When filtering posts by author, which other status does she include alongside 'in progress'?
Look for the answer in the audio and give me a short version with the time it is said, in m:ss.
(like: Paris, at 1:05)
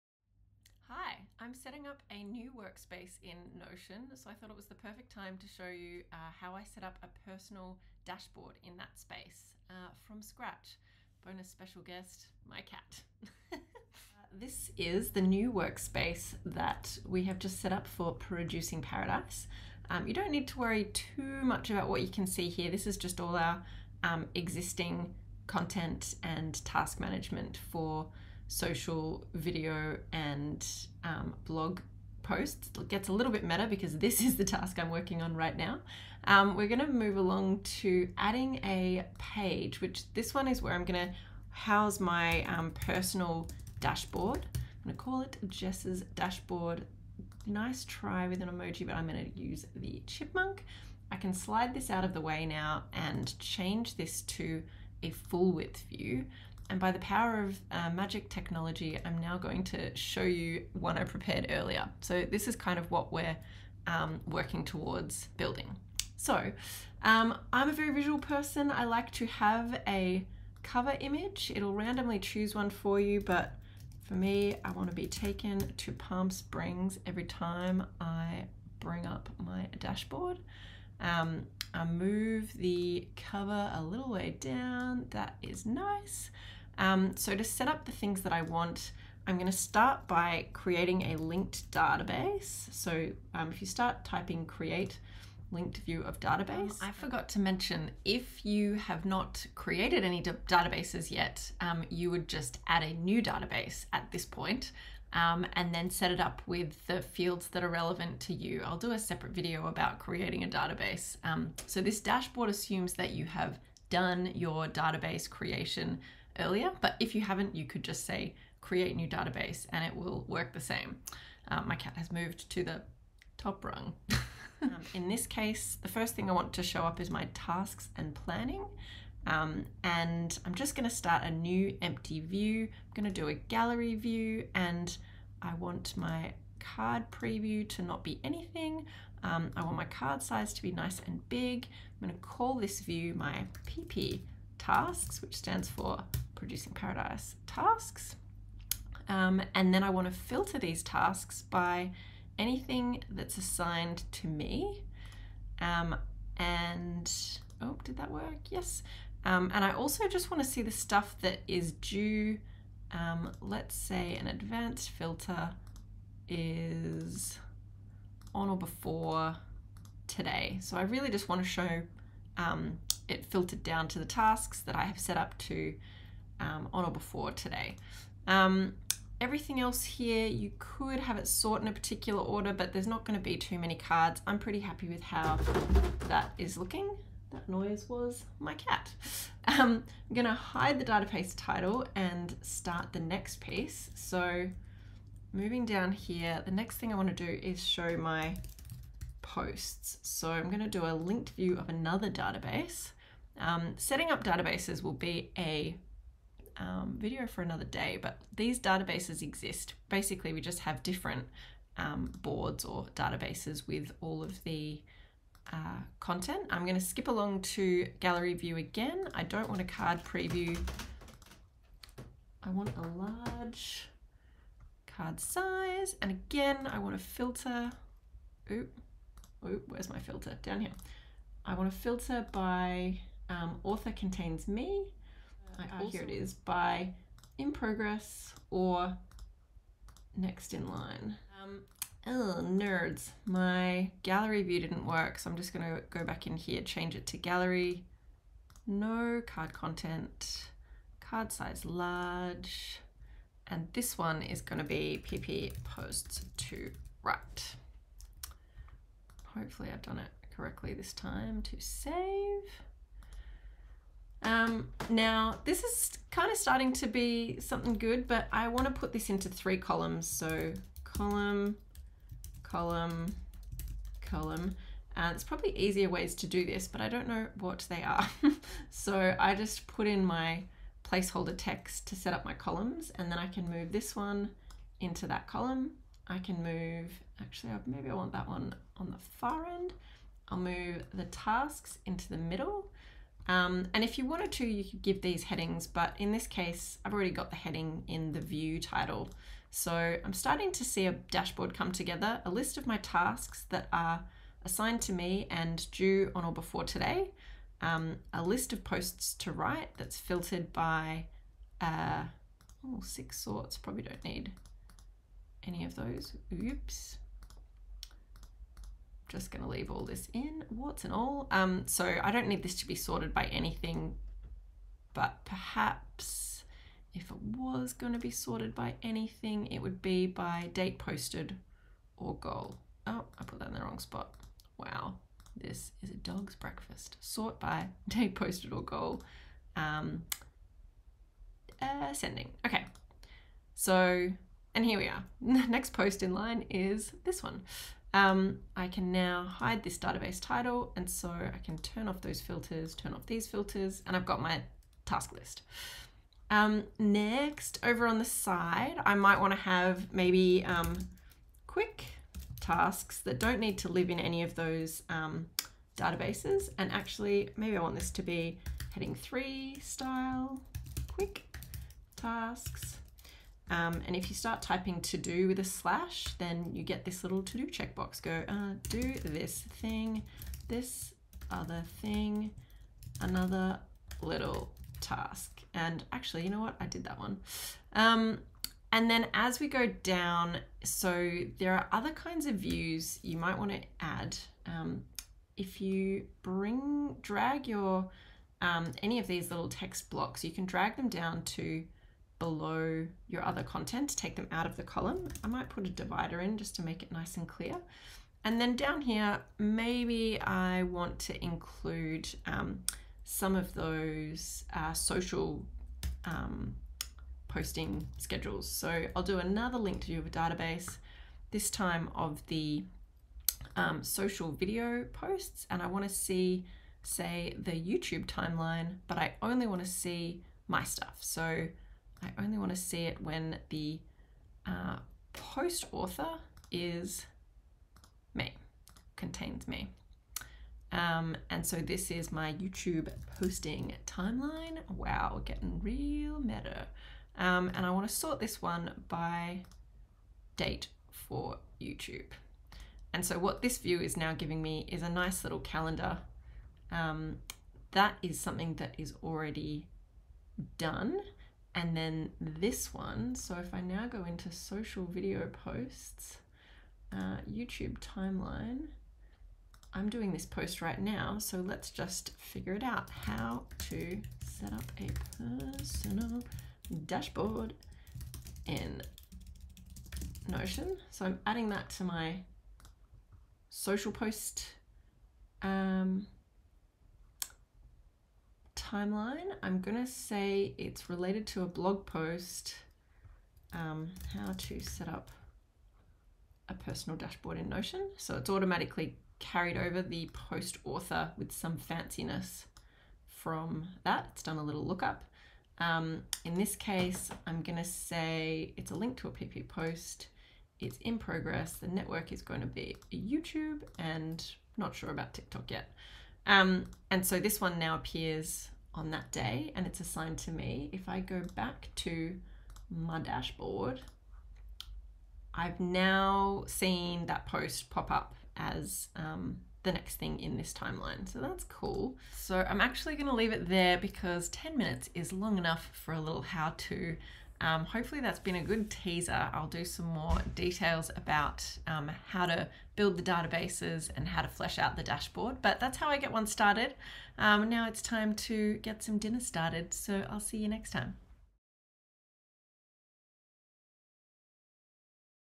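next in line, at 4:00.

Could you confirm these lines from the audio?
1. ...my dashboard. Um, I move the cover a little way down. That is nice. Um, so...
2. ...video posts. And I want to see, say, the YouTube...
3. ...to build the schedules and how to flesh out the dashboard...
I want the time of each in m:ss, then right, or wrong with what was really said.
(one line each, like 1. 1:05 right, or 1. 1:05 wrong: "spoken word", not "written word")
1. 1:19 right
2. 7:04 right
3. 9:02 wrong: "databases", not "schedules".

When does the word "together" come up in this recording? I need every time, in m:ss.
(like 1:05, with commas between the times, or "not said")
5:01.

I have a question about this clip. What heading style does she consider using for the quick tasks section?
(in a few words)
heading three.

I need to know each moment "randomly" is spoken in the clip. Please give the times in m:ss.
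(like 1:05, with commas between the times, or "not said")
1:11.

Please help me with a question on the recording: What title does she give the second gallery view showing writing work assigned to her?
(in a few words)
PP posts to write.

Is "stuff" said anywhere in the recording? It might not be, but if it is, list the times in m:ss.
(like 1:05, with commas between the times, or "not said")
2:40, 7:10.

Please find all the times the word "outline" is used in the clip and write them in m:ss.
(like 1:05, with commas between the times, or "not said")
not said.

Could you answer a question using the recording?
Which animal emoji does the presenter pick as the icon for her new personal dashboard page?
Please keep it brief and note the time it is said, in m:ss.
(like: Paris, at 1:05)
chipmunk, at 0:50.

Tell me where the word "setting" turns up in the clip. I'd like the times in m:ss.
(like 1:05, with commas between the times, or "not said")
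0:01, 3:23.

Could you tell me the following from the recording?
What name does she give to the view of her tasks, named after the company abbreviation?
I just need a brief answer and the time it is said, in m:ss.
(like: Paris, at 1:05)
my PP tasks, at 2:23.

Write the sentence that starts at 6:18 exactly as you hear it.
Go uh, do this thing, this other thing, another little task.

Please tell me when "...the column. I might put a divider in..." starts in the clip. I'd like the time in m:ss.
6:44.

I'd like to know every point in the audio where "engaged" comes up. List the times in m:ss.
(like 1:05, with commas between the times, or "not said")
not said.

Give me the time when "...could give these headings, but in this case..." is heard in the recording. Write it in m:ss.
4:54.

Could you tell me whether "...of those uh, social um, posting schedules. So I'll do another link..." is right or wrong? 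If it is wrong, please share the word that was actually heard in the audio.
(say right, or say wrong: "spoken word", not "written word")
right.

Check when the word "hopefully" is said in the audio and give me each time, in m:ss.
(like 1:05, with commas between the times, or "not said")
4:19, 8:57.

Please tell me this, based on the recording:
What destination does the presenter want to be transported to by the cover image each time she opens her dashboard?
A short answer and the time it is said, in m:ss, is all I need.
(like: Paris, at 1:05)
Palm Springs, at 1:15.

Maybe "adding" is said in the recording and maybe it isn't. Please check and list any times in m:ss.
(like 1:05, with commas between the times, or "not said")
0:38, 8:01.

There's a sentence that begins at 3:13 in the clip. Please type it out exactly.
So moving down here, the next thing I want to do is show my posts.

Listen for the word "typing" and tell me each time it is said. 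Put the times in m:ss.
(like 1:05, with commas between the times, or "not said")
1:34, 6:14.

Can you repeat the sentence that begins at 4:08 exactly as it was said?
No card content, card size large.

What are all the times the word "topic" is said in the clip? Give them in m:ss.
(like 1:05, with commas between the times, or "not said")
not said.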